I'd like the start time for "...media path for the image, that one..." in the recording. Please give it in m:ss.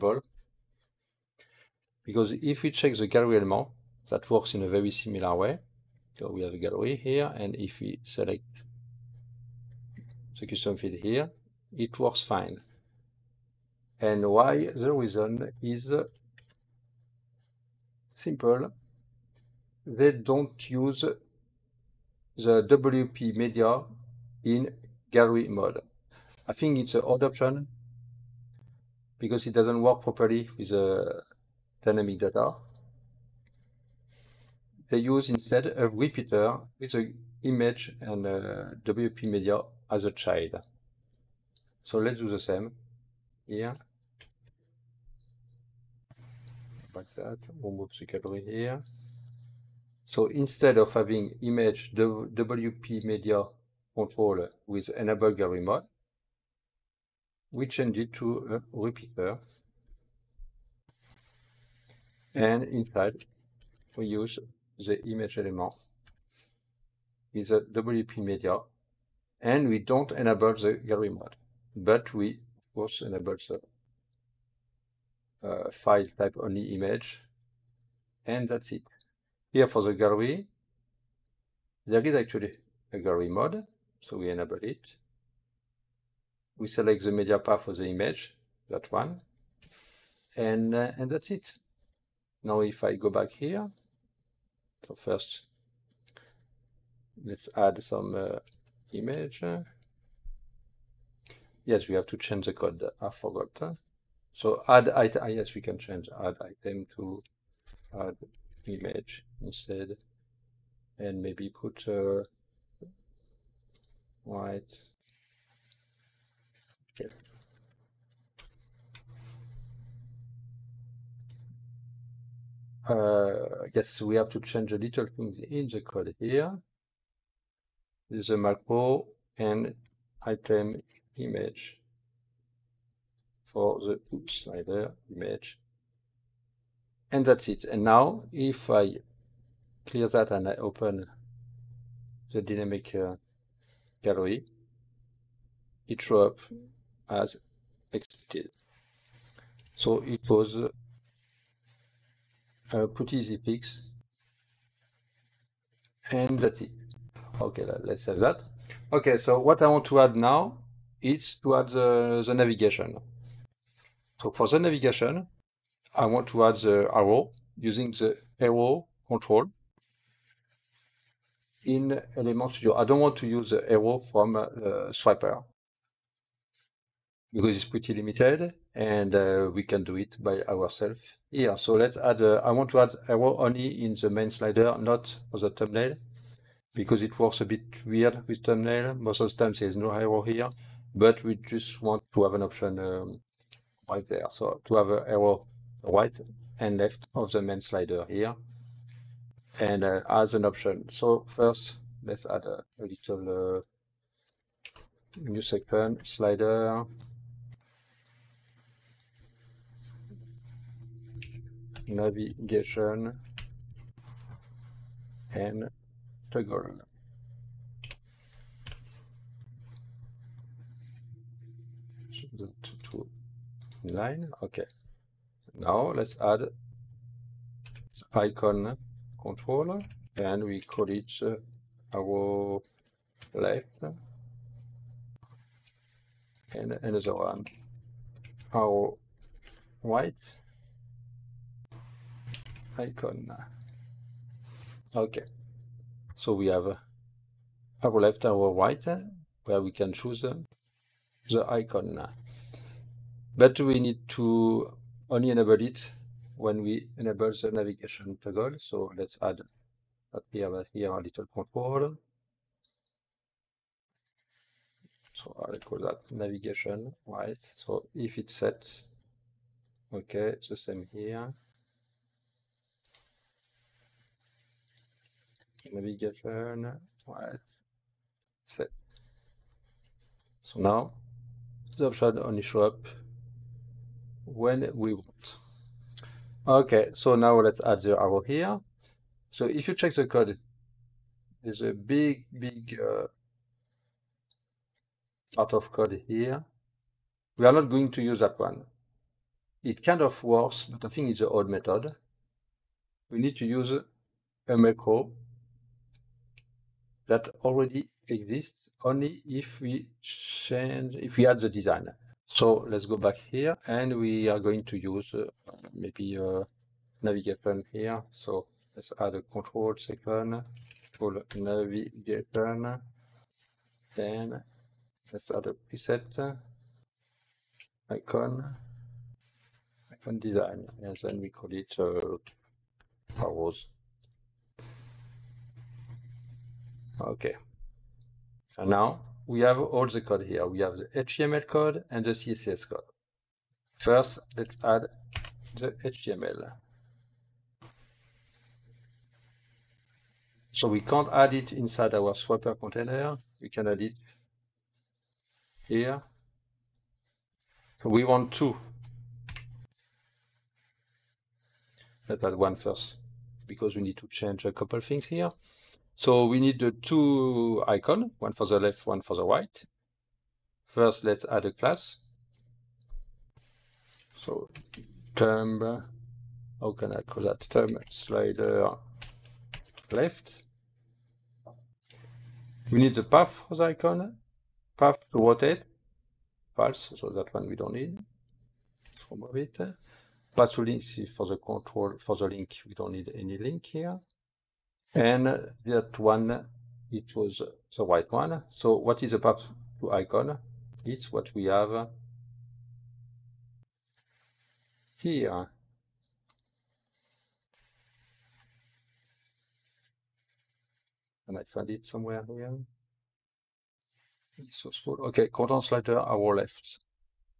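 1:27.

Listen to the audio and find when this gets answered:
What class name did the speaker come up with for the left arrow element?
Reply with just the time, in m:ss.
6:17.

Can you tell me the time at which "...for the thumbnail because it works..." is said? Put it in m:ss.
3:05.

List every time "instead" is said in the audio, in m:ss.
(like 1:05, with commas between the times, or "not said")
0:35, 0:50, 1:49.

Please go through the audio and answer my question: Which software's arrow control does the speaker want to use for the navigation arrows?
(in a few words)
Element Studio.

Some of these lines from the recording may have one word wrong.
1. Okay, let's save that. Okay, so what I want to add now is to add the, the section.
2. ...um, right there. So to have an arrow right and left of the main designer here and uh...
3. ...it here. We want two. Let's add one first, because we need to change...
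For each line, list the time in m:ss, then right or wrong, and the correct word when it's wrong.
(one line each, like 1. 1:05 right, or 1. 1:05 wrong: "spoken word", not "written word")
1. 2:37 wrong: "navigation", not "section"
2. 3:12 wrong: "slider", not "designer"
3. 5:53 right.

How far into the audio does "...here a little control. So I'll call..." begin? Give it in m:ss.
4:20.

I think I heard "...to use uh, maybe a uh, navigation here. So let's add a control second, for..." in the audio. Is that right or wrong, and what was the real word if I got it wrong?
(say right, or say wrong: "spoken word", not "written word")
right.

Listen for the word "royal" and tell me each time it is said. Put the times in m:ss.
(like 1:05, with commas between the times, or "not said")
not said.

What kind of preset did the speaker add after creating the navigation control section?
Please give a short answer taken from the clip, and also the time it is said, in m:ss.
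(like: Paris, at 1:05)
Icon design, at 5:29.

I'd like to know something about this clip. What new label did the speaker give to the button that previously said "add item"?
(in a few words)
Add image.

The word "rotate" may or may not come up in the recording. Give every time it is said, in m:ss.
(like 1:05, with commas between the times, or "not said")
6:25.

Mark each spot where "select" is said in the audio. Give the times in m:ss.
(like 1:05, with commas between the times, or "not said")
0:08, 1:26.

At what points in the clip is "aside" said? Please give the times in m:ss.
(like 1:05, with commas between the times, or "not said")
not said.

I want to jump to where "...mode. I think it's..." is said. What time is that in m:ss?
0:25.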